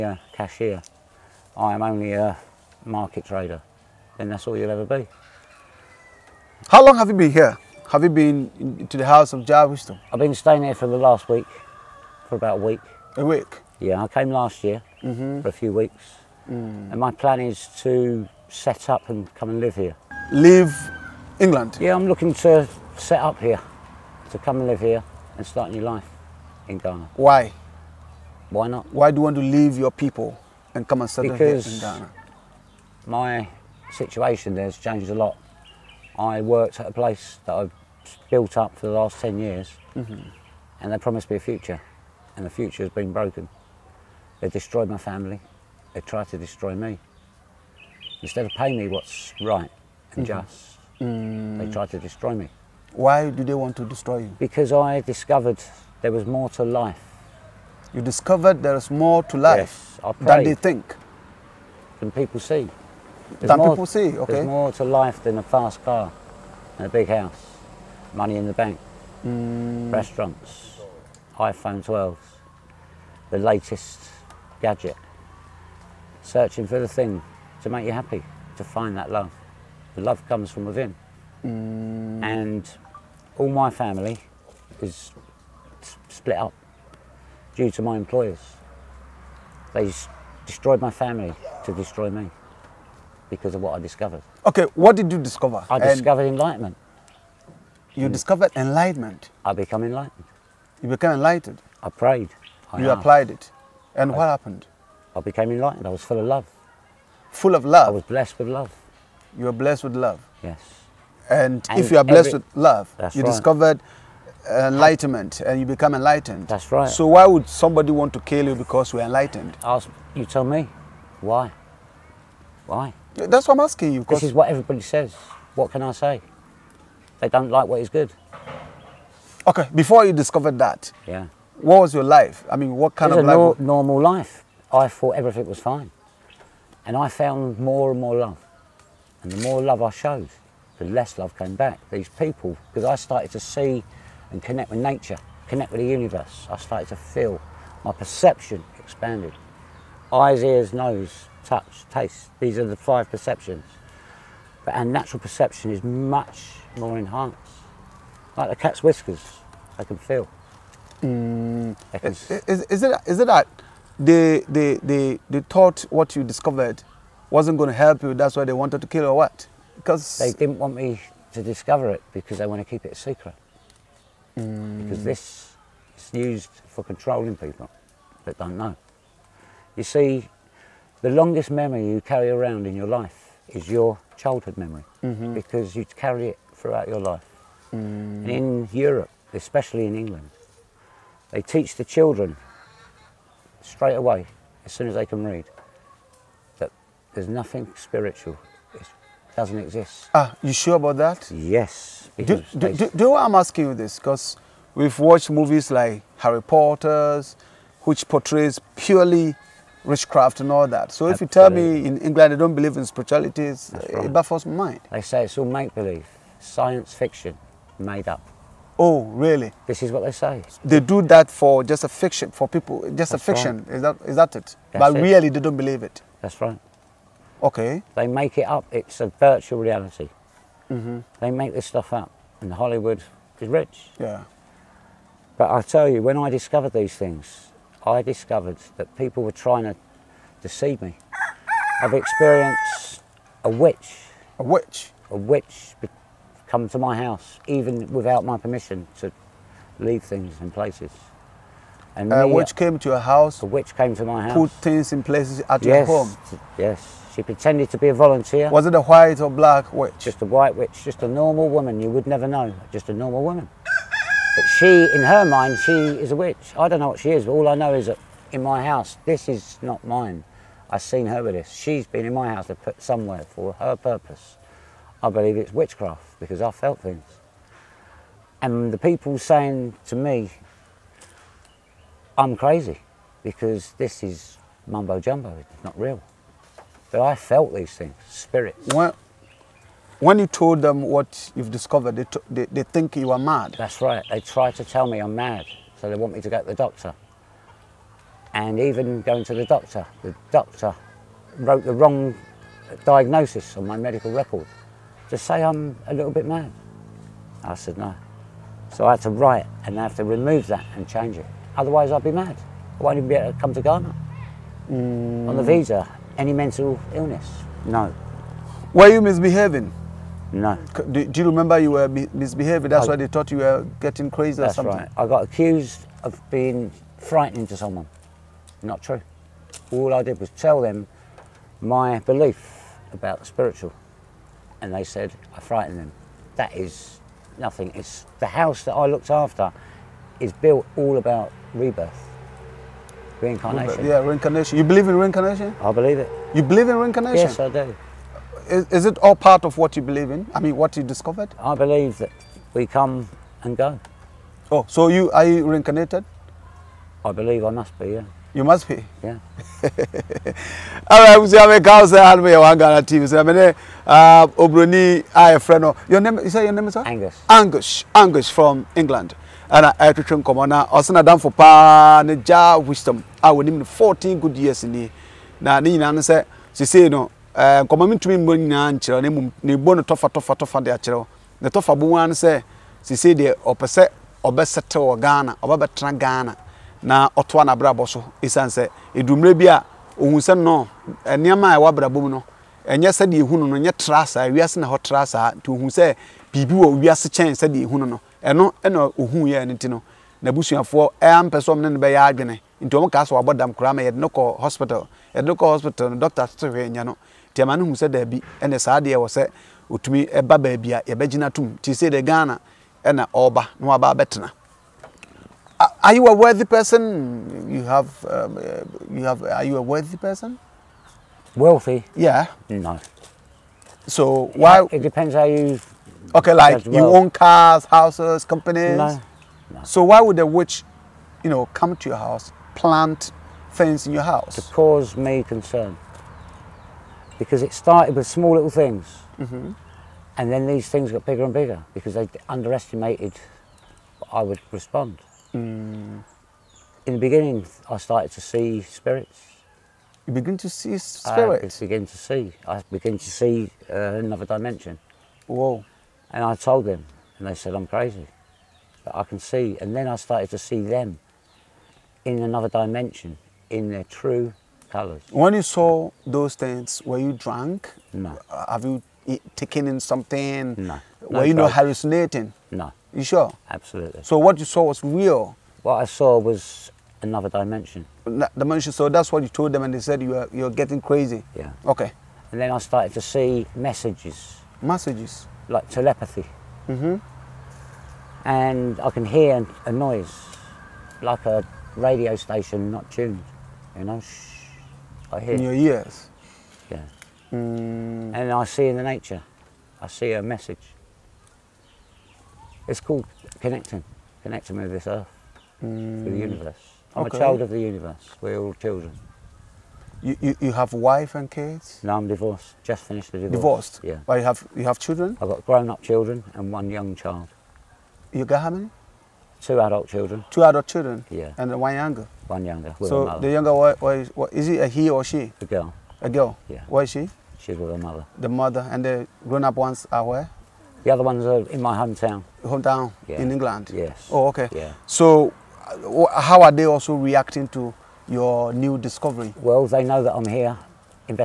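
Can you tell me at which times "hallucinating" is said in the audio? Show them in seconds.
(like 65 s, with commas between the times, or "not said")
471 s.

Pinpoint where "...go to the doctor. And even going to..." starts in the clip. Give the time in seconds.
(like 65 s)
296 s.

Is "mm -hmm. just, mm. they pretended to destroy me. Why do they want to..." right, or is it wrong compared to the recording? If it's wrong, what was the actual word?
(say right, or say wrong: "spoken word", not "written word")
wrong: "tried", not "pretended".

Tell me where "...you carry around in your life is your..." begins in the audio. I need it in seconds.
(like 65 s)
181 s.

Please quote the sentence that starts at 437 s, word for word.
Because it started with small little things, mm -hmm.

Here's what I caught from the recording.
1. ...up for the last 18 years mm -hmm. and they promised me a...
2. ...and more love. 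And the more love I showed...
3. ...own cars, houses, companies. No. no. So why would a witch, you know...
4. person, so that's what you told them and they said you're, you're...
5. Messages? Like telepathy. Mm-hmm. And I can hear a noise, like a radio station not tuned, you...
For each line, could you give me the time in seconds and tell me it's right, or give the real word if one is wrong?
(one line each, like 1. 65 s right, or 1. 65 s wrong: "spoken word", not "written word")
1. 38 s wrong: "10", not "18"
2. 137 s right
3. 426 s right
4. 478 s wrong: "dimension", not "person"
5. 484 s right.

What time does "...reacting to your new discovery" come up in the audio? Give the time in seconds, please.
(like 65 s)
536 s.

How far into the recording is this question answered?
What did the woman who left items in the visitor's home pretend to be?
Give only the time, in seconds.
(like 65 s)
257 s.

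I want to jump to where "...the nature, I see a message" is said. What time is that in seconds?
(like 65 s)
498 s.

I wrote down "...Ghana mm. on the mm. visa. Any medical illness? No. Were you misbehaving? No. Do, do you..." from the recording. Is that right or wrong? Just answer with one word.
wrong.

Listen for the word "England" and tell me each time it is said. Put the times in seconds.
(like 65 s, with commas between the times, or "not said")
21 s, 189 s, 211 s, 368 s, 533 s.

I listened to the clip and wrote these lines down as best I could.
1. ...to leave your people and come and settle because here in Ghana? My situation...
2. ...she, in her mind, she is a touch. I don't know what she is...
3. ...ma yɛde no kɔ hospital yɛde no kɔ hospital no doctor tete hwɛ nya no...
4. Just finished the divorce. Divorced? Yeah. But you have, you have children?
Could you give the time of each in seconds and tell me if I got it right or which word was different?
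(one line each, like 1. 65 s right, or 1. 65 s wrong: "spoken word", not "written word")
1. 29 s right
2. 264 s wrong: "witch", not "touch"
3. 403 s right
4. 512 s right.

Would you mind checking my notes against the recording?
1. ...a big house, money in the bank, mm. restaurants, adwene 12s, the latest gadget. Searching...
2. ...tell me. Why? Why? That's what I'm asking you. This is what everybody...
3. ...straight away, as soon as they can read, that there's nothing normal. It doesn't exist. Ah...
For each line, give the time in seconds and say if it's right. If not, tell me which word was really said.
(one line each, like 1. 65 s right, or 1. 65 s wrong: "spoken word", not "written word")
1. 66 s wrong: "iPhone", not "adwene"
2. 120 s right
3. 193 s wrong: "spiritual", not "normal".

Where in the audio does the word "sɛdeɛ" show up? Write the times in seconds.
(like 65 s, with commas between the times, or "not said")
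392 s, 397 s.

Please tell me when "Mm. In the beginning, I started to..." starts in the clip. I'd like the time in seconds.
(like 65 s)
445 s.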